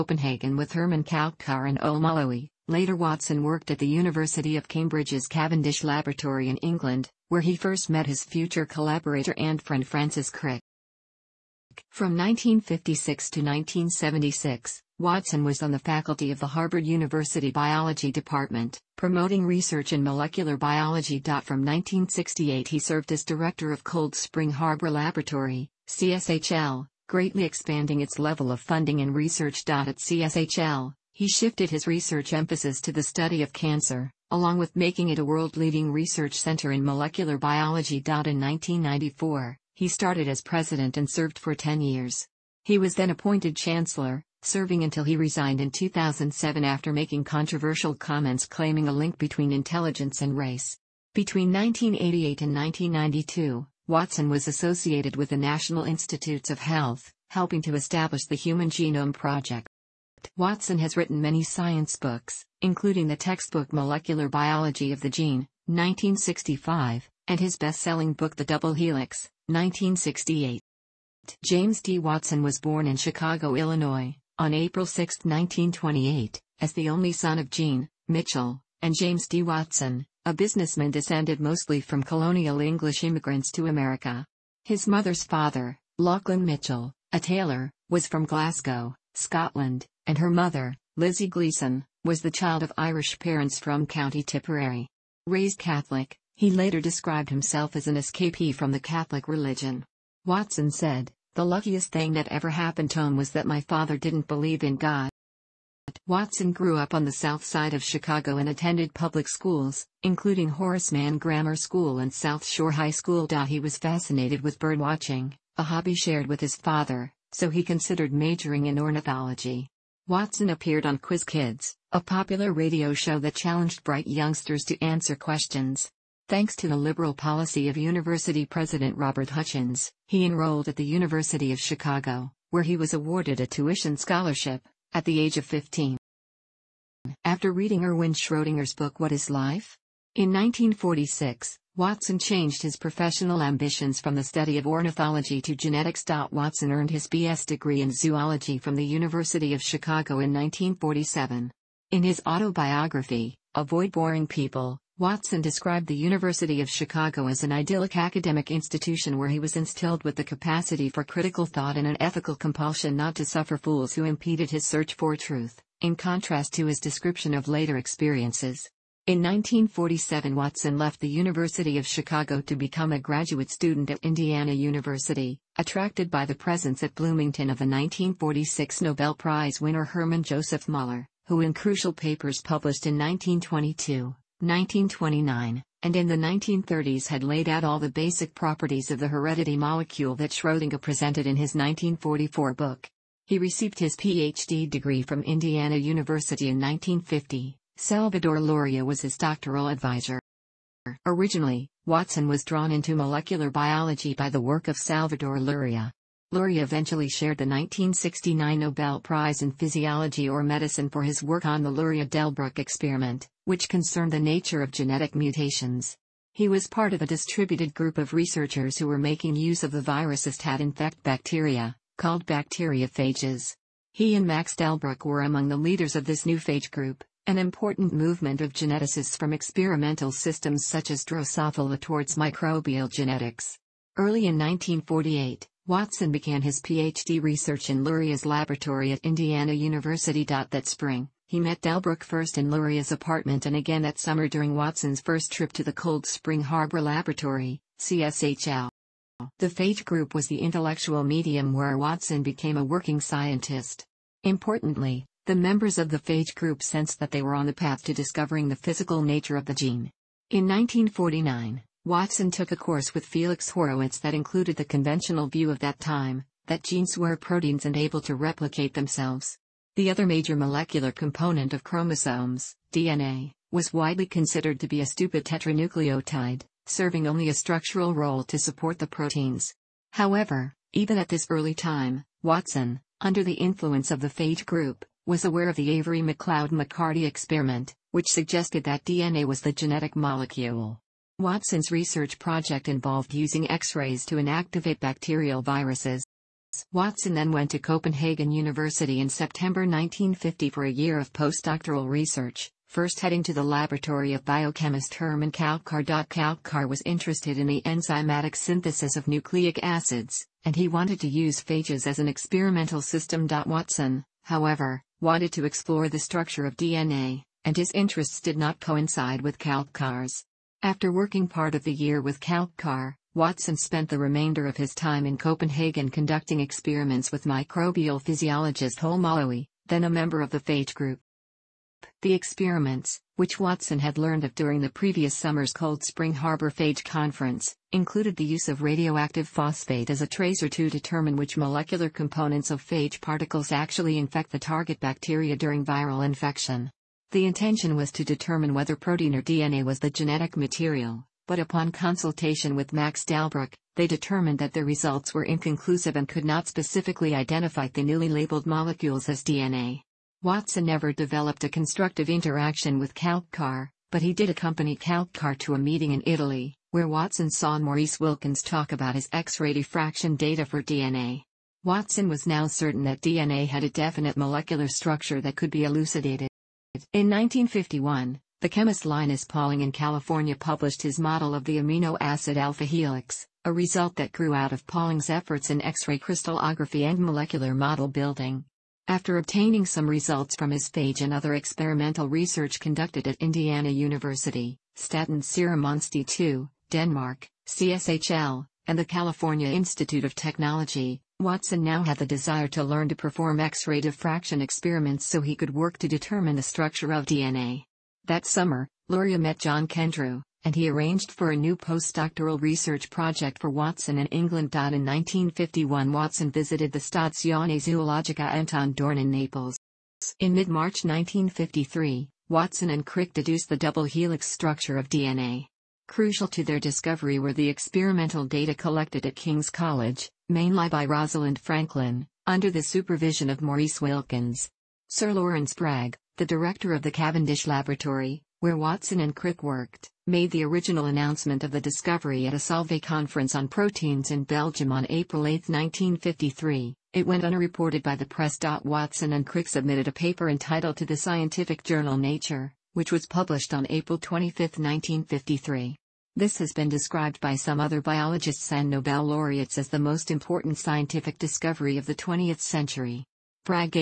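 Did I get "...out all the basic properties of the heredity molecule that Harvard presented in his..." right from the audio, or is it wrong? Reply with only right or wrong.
wrong.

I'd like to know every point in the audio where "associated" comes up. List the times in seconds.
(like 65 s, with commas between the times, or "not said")
54 s.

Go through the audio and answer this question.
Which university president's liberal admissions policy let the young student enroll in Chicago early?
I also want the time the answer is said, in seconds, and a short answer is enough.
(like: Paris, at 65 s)
Robert Hutchins, at 128 s.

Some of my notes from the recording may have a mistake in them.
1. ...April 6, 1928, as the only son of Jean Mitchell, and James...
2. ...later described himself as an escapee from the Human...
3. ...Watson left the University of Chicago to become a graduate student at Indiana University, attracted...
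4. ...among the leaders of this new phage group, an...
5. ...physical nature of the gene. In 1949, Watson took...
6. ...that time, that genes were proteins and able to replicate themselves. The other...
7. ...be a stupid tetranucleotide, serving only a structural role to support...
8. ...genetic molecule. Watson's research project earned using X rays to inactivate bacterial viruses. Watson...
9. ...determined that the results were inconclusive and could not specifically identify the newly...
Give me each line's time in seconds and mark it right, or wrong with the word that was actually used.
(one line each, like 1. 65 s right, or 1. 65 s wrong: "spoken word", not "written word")
1. 74 s right
2. 96 s wrong: "Catholic", not "Human"
3. 170 s right
4. 225 s right
5. 258 s right
6. 265 s right
7. 274 s right
8. 289 s wrong: "involved", not "earned"
9. 353 s right.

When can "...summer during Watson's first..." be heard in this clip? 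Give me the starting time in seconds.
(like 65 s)
243 s.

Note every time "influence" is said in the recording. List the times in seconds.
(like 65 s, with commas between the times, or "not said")
283 s.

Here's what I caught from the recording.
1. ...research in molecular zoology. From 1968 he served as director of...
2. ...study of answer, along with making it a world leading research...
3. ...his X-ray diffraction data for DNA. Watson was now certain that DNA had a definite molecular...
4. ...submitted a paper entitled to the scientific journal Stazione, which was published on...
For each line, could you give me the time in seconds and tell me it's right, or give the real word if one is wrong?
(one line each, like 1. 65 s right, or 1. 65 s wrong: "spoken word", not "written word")
1. 19 s wrong: "biology", not "zoology"
2. 33 s wrong: "cancer", not "answer"
3. 368 s right
4. 449 s wrong: "Nature", not "Stazione".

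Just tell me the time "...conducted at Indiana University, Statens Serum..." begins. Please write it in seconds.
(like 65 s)
392 s.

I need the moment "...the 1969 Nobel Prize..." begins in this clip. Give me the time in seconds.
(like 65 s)
207 s.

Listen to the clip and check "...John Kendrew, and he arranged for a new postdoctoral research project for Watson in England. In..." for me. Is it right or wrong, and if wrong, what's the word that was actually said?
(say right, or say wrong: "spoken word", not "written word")
right.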